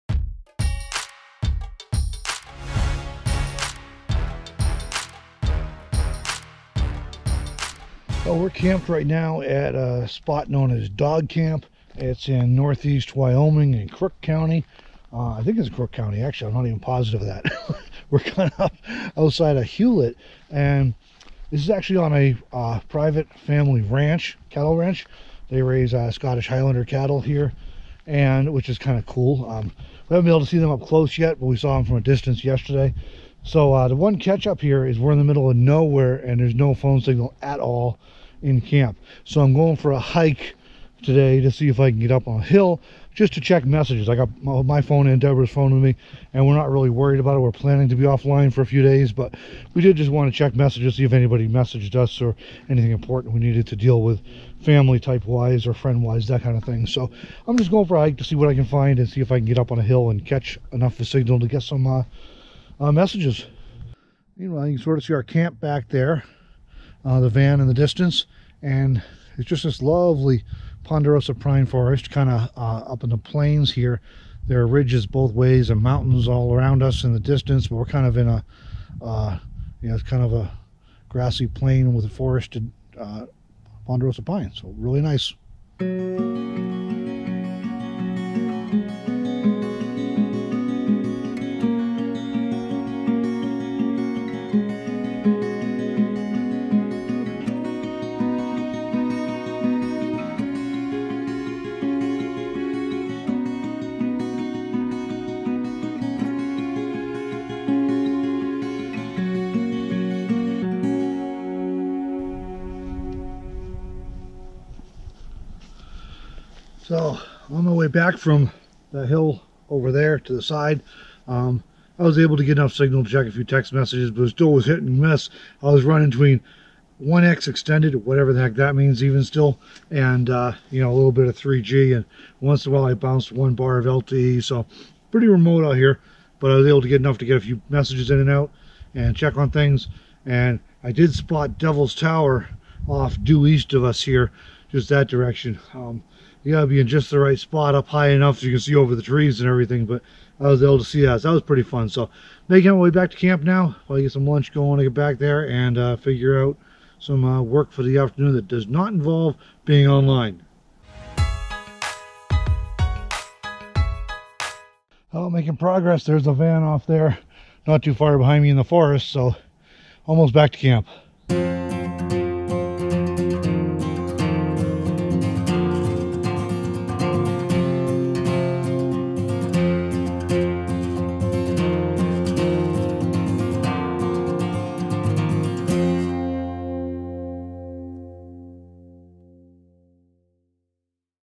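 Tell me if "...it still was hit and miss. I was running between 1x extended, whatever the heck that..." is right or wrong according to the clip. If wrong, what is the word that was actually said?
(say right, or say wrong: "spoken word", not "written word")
right.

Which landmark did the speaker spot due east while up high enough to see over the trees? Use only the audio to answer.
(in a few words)
Devil's Tower.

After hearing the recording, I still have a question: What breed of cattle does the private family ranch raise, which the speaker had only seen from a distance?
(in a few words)
Scottish Highlander.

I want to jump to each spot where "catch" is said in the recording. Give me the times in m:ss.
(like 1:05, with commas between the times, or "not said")
0:34, 1:00.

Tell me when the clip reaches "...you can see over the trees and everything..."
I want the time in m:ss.
2:28.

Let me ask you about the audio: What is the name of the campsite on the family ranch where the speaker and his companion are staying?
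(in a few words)
Dog Camp.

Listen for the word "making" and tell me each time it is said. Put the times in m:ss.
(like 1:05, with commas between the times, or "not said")
2:32, 2:45.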